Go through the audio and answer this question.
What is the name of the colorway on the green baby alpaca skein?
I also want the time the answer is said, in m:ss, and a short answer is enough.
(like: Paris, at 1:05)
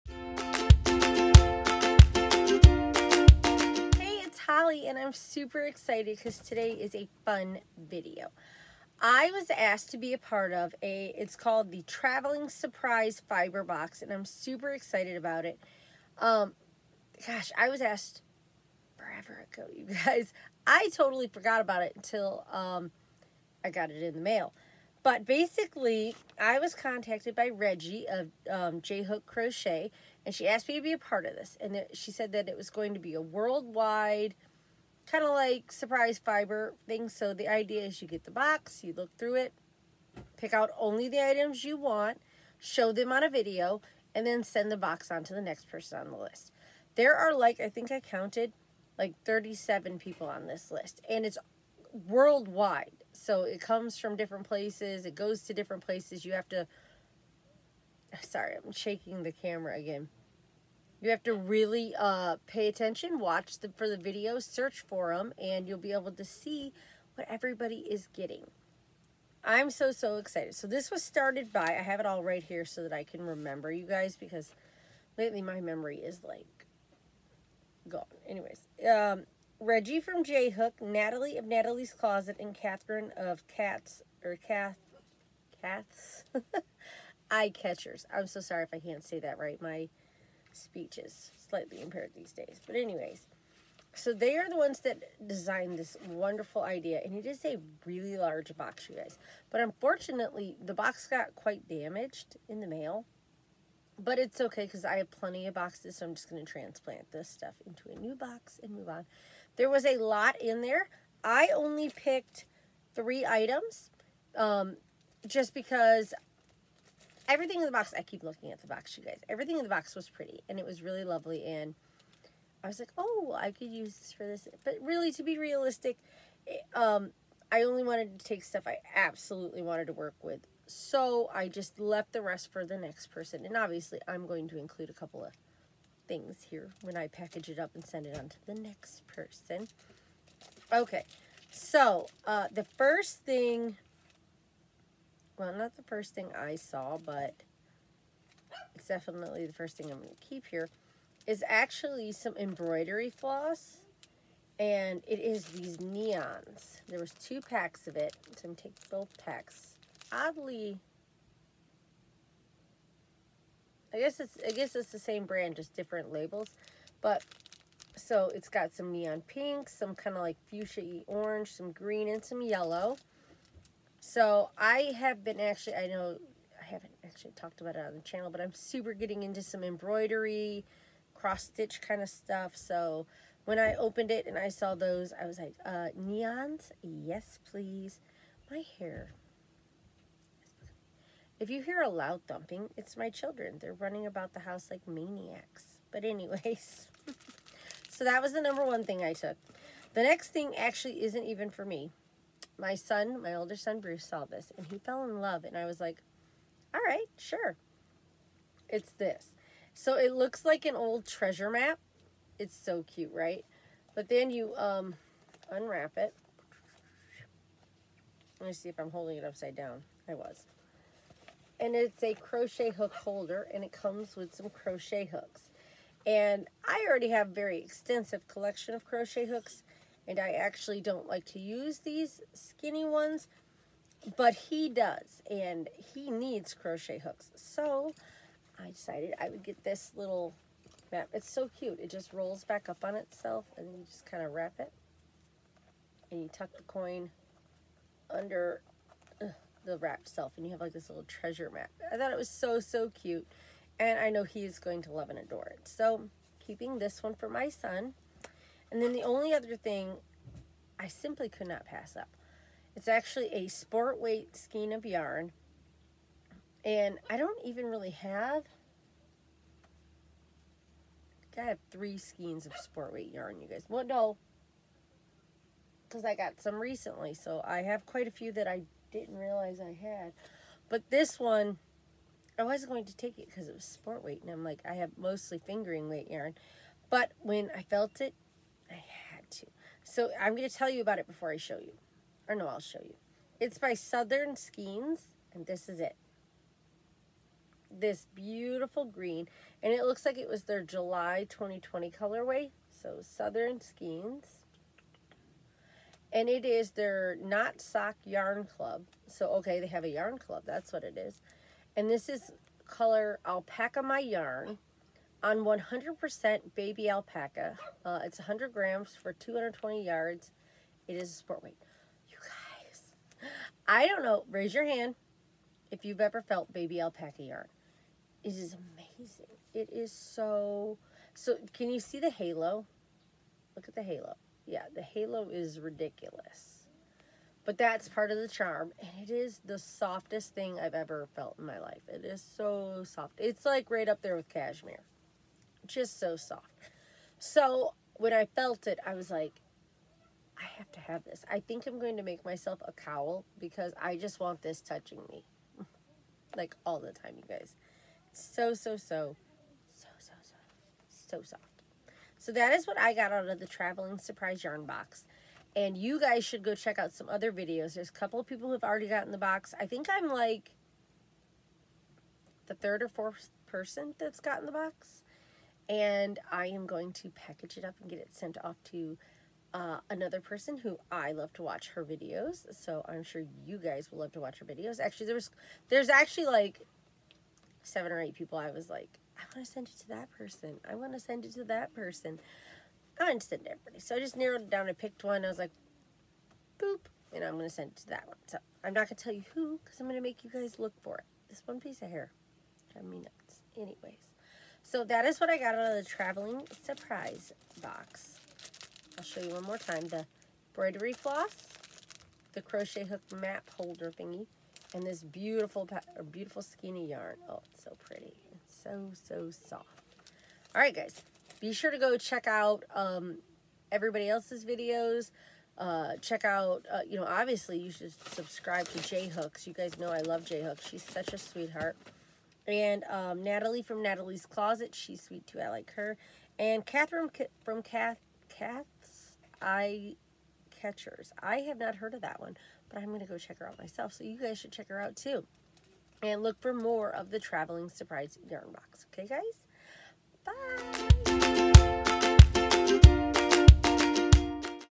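Alpaca My Yarn, at 5:13.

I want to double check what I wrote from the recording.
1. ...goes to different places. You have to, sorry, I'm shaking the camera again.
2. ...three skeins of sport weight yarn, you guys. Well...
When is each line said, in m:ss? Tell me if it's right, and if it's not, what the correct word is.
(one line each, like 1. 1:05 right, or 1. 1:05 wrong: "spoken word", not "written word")
1. 0:55 right
2. 4:31 right.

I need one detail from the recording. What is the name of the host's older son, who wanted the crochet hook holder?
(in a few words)
Bruce.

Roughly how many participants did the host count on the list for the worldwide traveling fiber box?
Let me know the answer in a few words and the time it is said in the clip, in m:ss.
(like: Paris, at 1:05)
37, at 0:49.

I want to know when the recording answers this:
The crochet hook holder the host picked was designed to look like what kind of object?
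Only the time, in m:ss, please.
3:30.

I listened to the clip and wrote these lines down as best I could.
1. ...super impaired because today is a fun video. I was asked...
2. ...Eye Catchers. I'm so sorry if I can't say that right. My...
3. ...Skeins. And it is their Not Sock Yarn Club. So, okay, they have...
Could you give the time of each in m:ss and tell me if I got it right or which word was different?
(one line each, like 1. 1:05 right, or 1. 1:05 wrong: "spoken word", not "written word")
1. 0:05 wrong: "excited", not "impaired"
2. 1:27 right
3. 5:03 right.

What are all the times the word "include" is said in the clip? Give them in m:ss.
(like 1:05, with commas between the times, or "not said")
2:14.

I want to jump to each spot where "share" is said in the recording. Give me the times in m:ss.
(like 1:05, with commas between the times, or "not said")
not said.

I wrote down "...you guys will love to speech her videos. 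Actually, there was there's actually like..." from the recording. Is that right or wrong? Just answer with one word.
wrong.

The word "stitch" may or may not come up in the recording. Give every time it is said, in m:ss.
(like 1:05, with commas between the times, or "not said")
3:01.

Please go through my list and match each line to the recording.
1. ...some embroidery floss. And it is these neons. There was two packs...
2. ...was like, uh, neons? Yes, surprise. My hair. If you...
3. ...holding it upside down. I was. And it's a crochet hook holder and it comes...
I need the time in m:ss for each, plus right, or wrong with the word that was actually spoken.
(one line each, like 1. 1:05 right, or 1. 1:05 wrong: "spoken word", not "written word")
1. 2:32 right
2. 3:05 wrong: "please", not "surprise"
3. 3:38 right.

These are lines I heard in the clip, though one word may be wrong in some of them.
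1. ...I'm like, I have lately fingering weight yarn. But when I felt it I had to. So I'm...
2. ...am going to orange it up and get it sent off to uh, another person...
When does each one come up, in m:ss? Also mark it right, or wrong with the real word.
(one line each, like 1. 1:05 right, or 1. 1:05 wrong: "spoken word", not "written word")
1. 4:44 wrong: "mostly", not "lately"
2. 6:16 wrong: "package", not "orange".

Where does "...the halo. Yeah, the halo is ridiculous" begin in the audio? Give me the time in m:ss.
5:33.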